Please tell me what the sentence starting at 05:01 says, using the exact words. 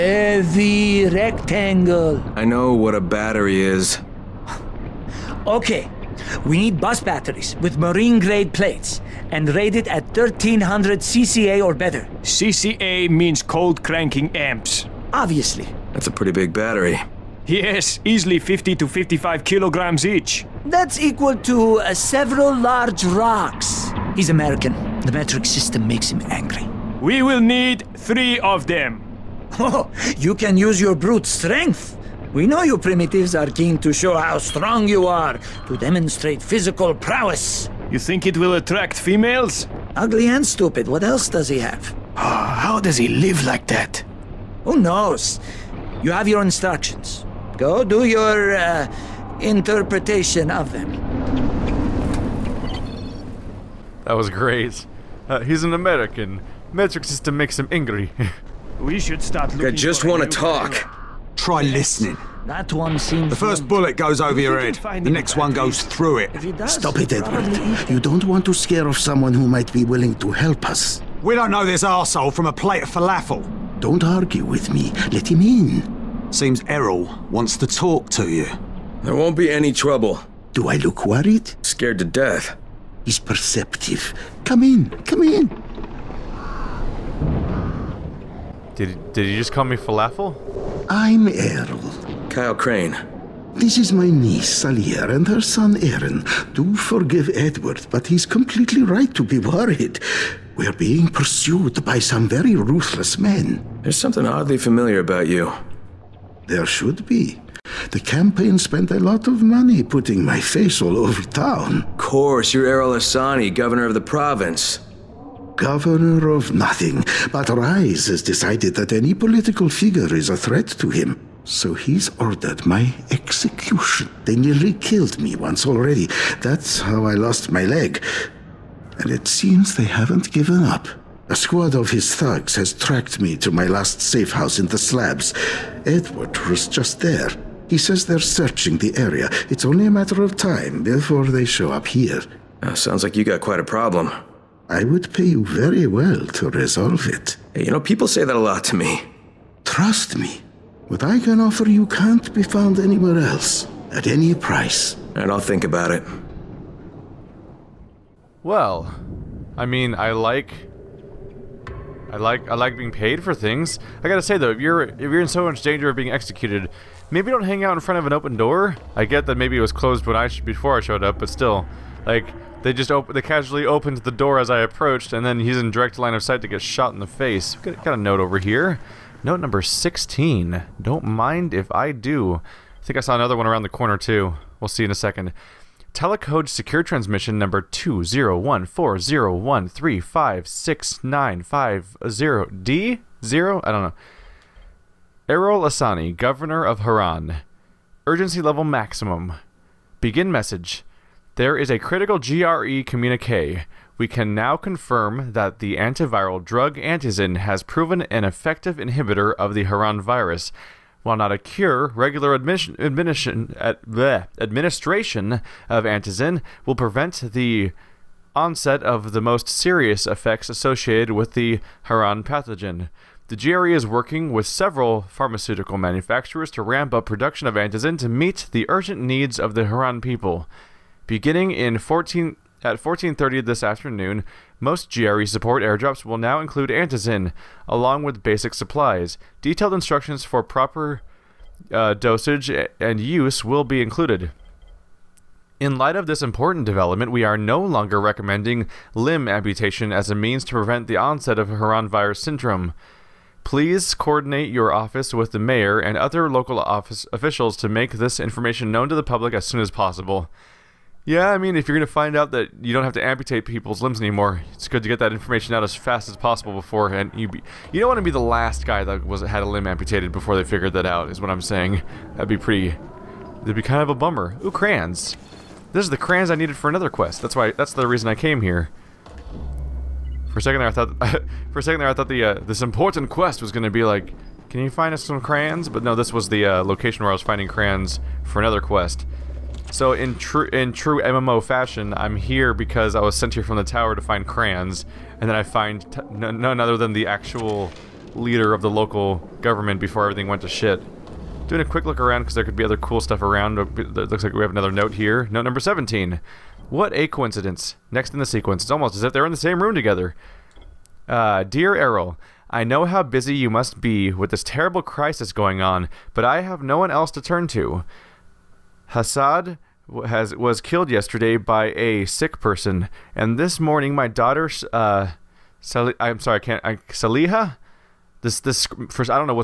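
Doing a quick look around because there could be other cool stuff around.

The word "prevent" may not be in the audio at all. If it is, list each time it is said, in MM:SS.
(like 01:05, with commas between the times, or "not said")
03:36, 04:10.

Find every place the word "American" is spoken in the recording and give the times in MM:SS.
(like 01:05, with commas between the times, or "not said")
00:24, 00:55.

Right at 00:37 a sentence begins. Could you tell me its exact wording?
You think it will attract females?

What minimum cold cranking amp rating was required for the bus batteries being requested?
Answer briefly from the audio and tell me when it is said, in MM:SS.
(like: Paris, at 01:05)
1300 CCA, at 00:10.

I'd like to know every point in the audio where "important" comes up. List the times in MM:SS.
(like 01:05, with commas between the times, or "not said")
04:06, 04:42.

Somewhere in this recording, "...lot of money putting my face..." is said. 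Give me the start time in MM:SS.
01:48.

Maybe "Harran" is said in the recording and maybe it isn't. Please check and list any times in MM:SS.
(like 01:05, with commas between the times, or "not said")
03:16, 03:29, 03:41, 03:49, 04:11.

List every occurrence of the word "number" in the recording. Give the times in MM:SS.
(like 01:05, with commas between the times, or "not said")
02:59, 03:07, 05:05.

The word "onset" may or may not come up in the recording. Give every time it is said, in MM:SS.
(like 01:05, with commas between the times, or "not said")
03:38, 04:10.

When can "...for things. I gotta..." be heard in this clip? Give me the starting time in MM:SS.
02:43.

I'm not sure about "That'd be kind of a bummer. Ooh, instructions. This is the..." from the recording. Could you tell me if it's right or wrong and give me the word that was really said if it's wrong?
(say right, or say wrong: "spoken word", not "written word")
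wrong: "crayons", not "instructions".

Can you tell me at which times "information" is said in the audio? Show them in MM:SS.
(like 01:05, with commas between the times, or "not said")
04:18, 04:25.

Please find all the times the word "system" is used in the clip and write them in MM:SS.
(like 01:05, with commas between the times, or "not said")
00:25, 00:57.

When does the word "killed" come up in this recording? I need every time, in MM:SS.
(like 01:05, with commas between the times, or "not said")
02:04, 05:20.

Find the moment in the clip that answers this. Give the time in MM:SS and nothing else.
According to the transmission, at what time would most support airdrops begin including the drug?
03:52.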